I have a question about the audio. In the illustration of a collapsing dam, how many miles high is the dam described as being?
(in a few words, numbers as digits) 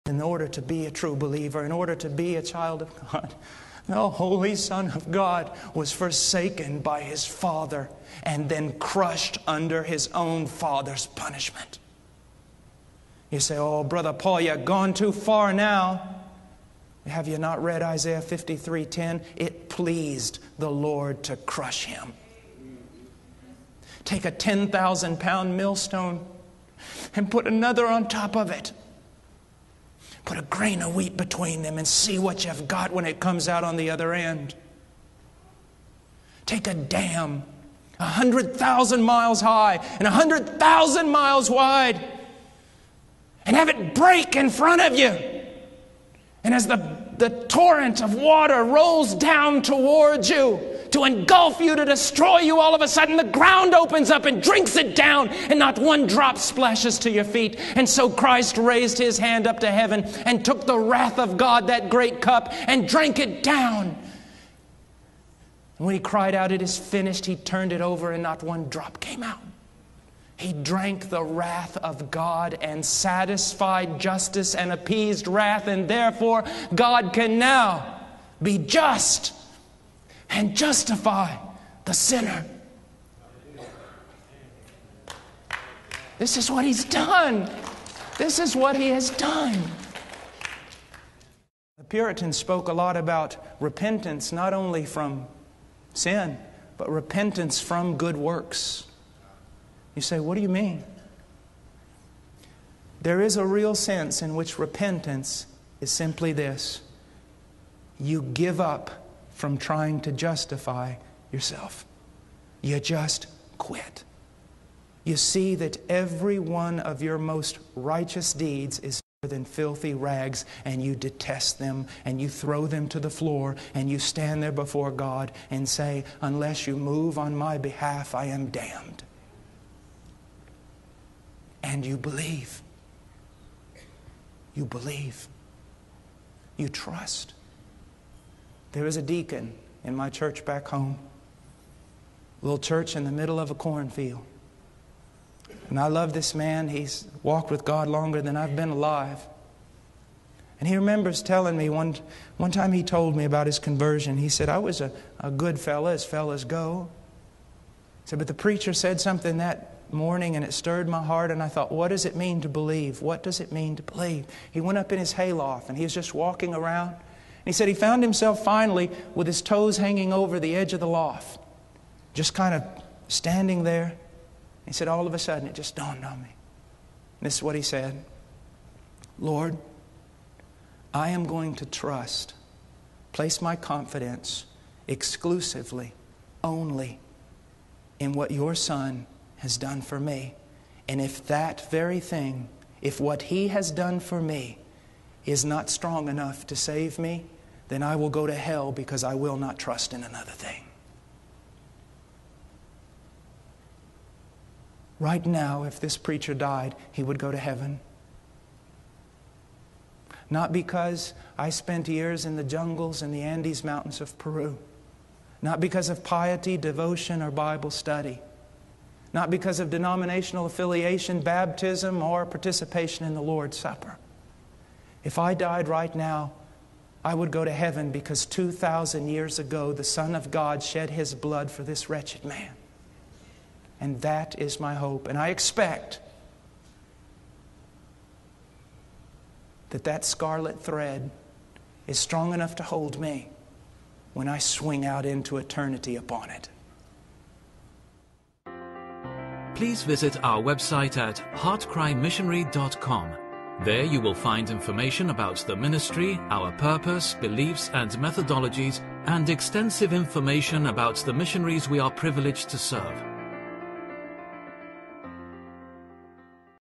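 100,000.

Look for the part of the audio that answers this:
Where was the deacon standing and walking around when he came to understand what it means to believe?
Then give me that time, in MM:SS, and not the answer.
02:45.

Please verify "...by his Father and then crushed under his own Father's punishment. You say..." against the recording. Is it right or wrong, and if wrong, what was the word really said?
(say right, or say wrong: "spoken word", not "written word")
right.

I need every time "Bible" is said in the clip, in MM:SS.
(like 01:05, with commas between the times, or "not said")
03:37.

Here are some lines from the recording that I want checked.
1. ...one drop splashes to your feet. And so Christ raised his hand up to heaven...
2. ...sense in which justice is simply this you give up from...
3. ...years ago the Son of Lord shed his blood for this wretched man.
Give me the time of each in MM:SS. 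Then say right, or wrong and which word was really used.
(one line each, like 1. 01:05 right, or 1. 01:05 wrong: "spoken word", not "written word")
1. 00:55 right
2. 01:43 wrong: "repentance", not "justice"
3. 03:49 wrong: "God", not "Lord".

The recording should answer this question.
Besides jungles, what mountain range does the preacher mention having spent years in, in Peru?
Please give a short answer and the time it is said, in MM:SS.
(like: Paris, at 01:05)
Andes Mountains, at 03:33.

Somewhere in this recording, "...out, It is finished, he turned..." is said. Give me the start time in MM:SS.
01:06.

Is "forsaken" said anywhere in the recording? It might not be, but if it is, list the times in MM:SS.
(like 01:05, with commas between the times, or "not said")
00:05.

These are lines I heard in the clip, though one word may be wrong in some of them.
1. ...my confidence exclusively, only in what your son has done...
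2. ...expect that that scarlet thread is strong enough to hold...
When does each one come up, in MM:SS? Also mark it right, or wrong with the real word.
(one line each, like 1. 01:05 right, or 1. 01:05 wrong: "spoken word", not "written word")
1. 03:03 right
2. 03:55 right.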